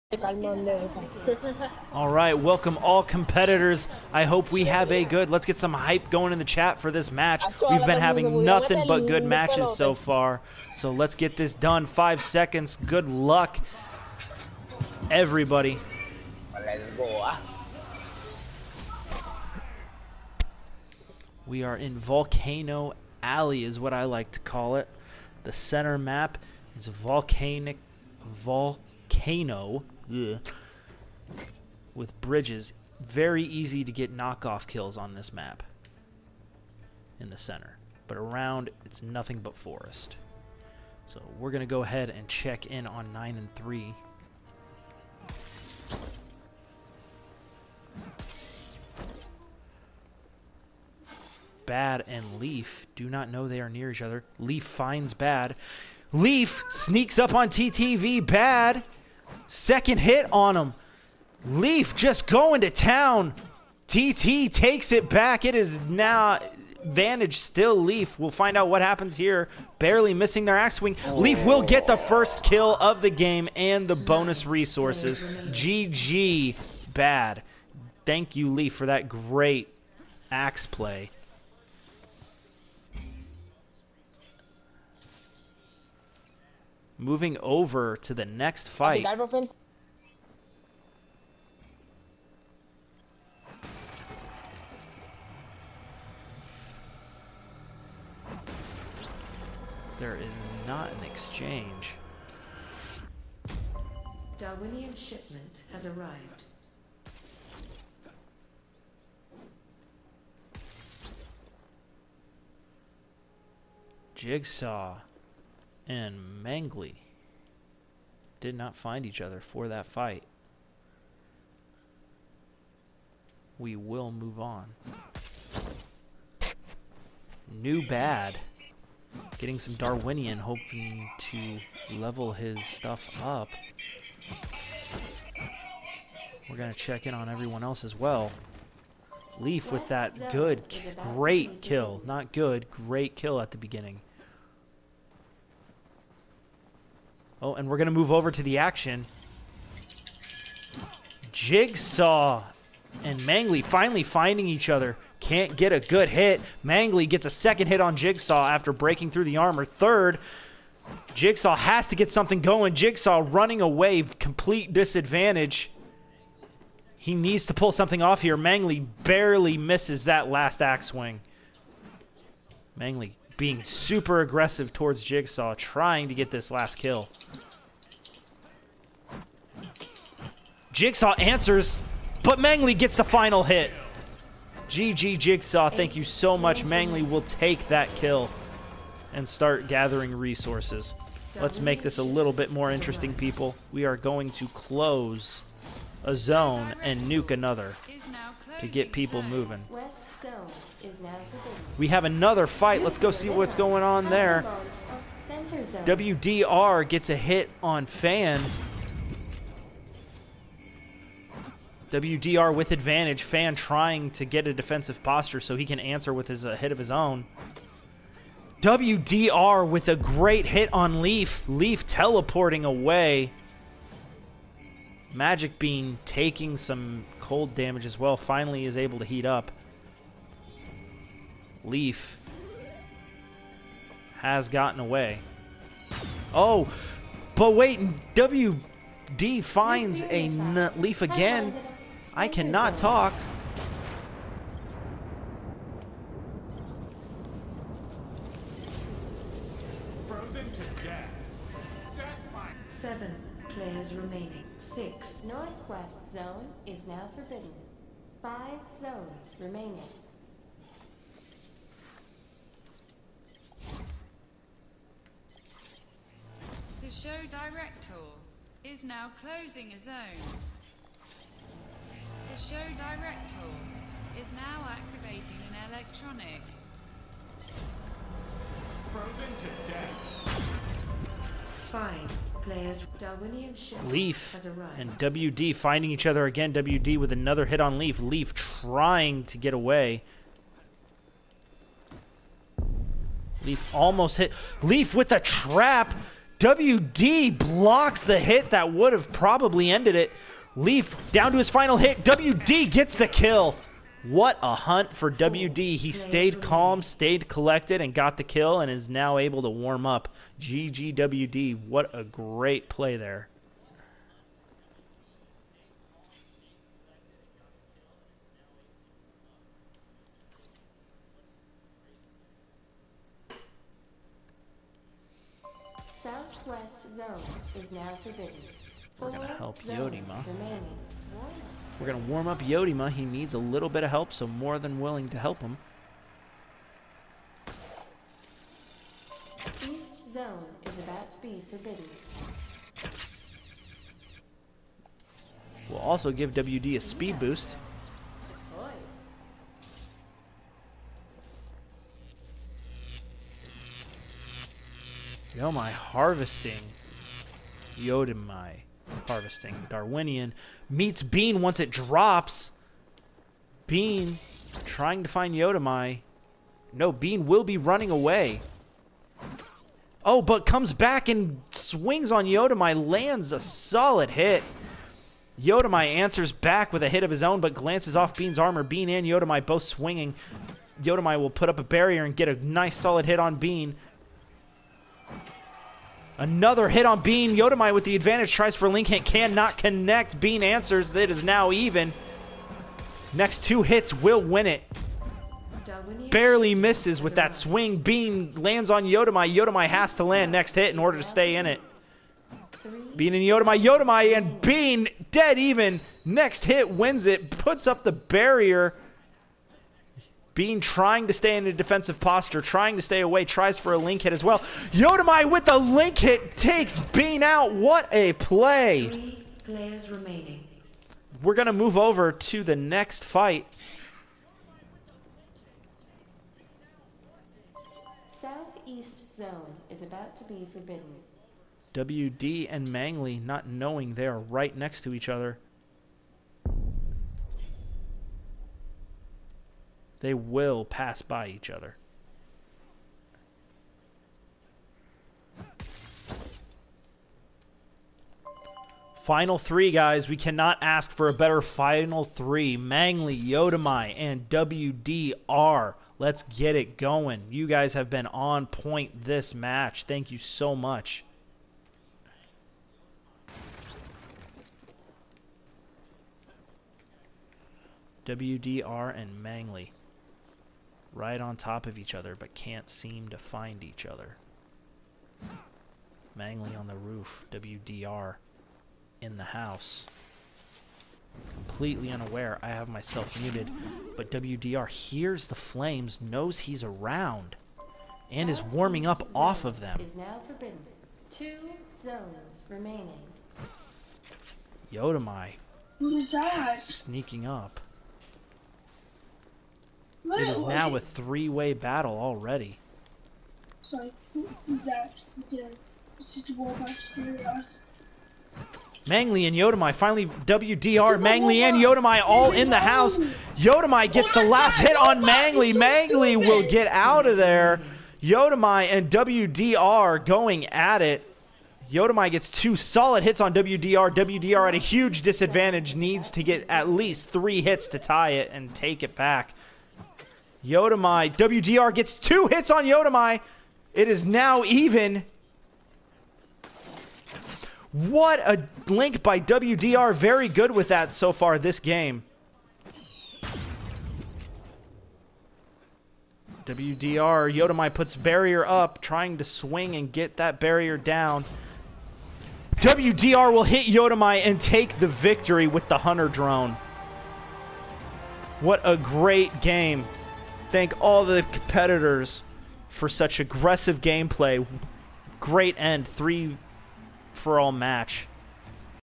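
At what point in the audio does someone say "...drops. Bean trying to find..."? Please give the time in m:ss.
6:01.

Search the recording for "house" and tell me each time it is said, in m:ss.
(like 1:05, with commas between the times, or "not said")
7:59, 8:32.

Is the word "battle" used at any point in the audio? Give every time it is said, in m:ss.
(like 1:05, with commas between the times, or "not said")
8:21.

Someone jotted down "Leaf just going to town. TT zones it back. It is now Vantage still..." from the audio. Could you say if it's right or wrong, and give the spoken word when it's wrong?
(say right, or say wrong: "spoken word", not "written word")
wrong: "takes", not "zones".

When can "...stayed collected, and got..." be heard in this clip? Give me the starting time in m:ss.
5:06.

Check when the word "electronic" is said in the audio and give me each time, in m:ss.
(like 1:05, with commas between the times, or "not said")
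4:35.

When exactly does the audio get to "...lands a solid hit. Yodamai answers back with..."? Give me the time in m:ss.
6:12.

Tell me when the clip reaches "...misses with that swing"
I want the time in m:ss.
6:36.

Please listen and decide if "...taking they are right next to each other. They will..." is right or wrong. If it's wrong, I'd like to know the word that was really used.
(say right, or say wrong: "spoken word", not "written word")
wrong: "knowing", not "taking".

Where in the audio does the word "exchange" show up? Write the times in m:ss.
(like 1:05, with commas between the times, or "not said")
1:41.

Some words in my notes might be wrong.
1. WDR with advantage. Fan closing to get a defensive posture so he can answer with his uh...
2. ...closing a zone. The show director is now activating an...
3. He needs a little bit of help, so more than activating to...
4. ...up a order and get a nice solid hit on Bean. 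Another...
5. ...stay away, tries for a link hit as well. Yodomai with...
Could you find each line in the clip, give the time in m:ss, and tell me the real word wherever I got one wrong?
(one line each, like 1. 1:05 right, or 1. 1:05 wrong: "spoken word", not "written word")
1. 3:31 wrong: "trying", not "closing"
2. 4:29 right
3. 5:32 wrong: "willing", not "activating"
4. 6:21 wrong: "barrier", not "order"
5. 6:52 right.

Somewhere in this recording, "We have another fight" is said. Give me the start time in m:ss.
3:21.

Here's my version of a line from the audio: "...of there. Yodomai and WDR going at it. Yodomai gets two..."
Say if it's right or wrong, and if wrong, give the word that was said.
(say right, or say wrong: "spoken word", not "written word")
right.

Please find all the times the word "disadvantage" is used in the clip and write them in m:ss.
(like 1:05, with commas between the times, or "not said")
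2:44, 8:45.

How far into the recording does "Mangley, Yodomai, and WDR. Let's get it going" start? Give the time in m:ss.
7:32.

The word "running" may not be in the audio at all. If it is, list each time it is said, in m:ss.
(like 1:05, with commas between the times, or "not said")
2:43, 6:07.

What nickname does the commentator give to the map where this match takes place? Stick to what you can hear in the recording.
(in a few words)
Volcano Alley.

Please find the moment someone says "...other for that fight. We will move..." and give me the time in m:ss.
1:59.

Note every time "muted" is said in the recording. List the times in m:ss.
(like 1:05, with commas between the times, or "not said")
8:03.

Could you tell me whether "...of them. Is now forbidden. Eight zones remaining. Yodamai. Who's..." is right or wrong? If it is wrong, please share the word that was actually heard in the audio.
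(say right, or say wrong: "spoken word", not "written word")
wrong: "Two", not "Eight".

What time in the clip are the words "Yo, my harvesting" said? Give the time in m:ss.
5:55.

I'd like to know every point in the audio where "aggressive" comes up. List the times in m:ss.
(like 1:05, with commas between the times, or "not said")
2:54, 9:23.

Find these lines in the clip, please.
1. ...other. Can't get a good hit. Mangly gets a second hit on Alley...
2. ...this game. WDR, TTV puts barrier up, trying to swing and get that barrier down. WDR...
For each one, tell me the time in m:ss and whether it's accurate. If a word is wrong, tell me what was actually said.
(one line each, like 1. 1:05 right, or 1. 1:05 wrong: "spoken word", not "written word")
1. 2:34 wrong: "Jigsaw", not "Alley"
2. 9:01 wrong: "Yodomai", not "TTV".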